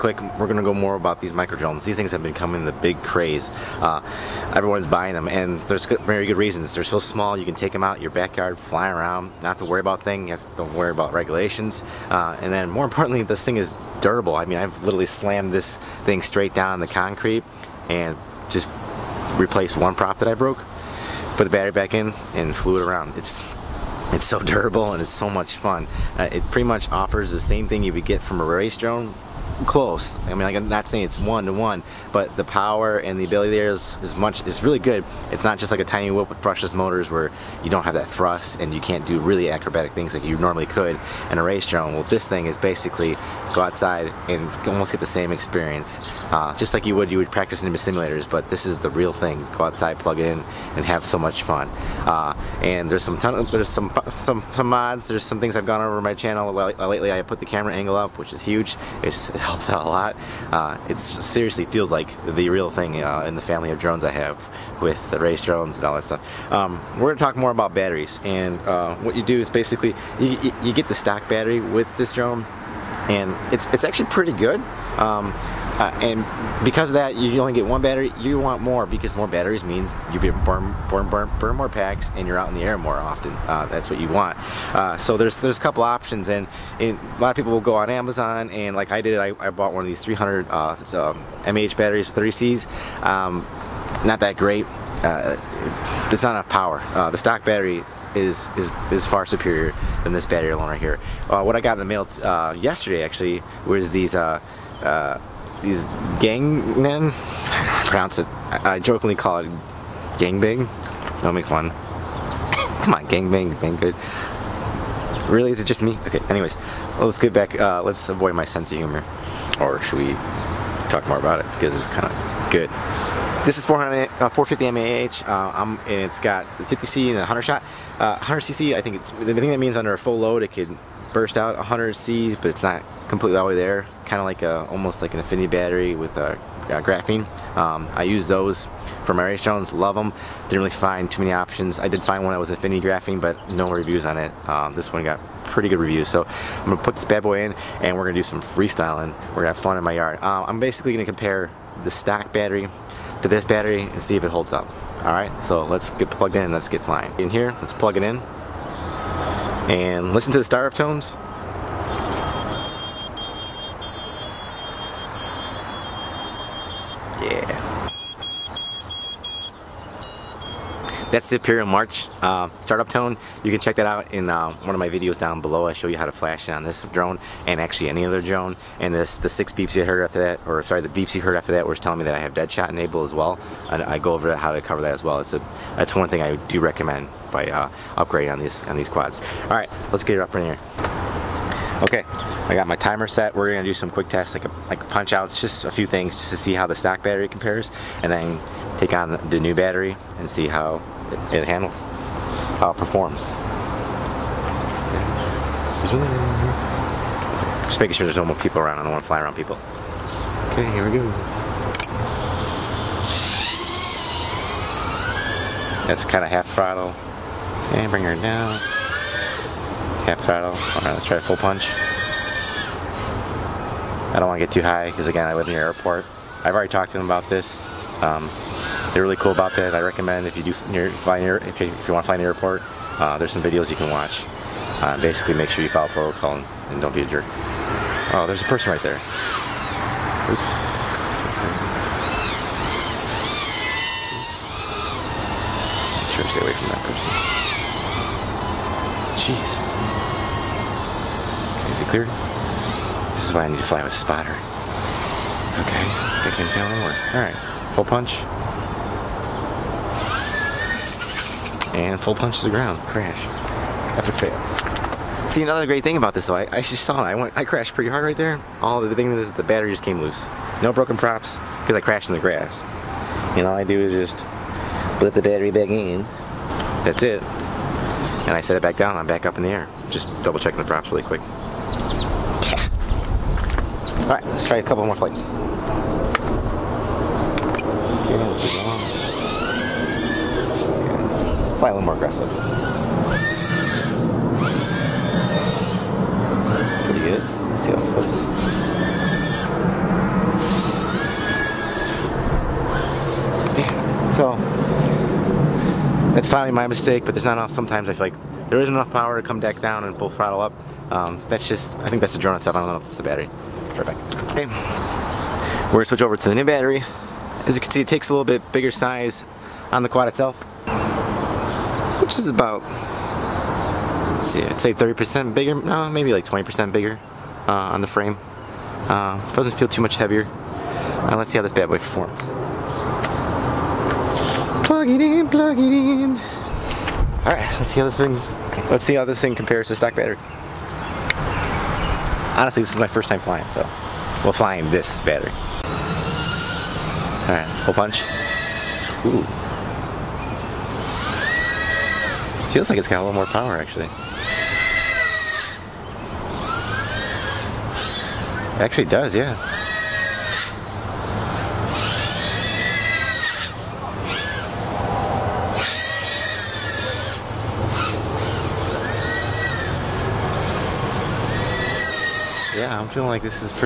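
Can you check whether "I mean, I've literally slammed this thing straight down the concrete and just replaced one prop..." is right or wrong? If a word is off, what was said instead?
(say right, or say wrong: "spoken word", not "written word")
right.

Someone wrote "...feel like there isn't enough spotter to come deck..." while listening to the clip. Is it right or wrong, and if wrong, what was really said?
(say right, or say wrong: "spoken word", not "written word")
wrong: "power", not "spotter".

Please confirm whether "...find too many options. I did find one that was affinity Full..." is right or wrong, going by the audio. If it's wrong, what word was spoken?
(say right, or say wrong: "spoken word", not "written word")
wrong: "Graphene", not "Full".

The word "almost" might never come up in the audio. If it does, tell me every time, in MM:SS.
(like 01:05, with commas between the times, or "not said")
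00:44, 02:14.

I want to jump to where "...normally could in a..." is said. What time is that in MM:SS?
00:40.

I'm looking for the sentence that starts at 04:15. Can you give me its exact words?
Okay, I can't can tell more.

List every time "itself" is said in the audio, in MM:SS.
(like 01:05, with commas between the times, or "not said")
05:12, 05:20.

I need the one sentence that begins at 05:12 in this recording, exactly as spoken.
I don't know if it's the battery.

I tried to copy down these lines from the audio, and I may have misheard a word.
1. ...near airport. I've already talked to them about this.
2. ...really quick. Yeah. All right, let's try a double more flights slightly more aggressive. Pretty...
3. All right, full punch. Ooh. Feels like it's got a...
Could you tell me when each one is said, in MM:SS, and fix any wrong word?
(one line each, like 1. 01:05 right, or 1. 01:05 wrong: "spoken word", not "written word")
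1. 03:45 right
2. 04:40 wrong: "couple", not "double"
3. 05:47 right.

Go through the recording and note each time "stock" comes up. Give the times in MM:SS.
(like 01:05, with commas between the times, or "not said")
01:10, 01:37, 02:31, 03:16, 05:39.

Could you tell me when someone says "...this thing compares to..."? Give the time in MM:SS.
05:39.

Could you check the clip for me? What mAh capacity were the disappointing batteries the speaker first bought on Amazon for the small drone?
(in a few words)
300.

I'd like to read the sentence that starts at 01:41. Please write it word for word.
what I got in the mail yesterday actually was these these Gaoneng, pronounce it, I, jokingly call it gangbang.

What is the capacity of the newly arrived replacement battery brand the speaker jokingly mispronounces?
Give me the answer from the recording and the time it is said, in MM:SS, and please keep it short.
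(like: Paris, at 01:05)
450 mAh, at 02:04.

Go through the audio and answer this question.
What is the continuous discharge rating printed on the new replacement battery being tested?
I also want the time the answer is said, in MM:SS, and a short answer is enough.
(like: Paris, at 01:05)
50C, at 02:06.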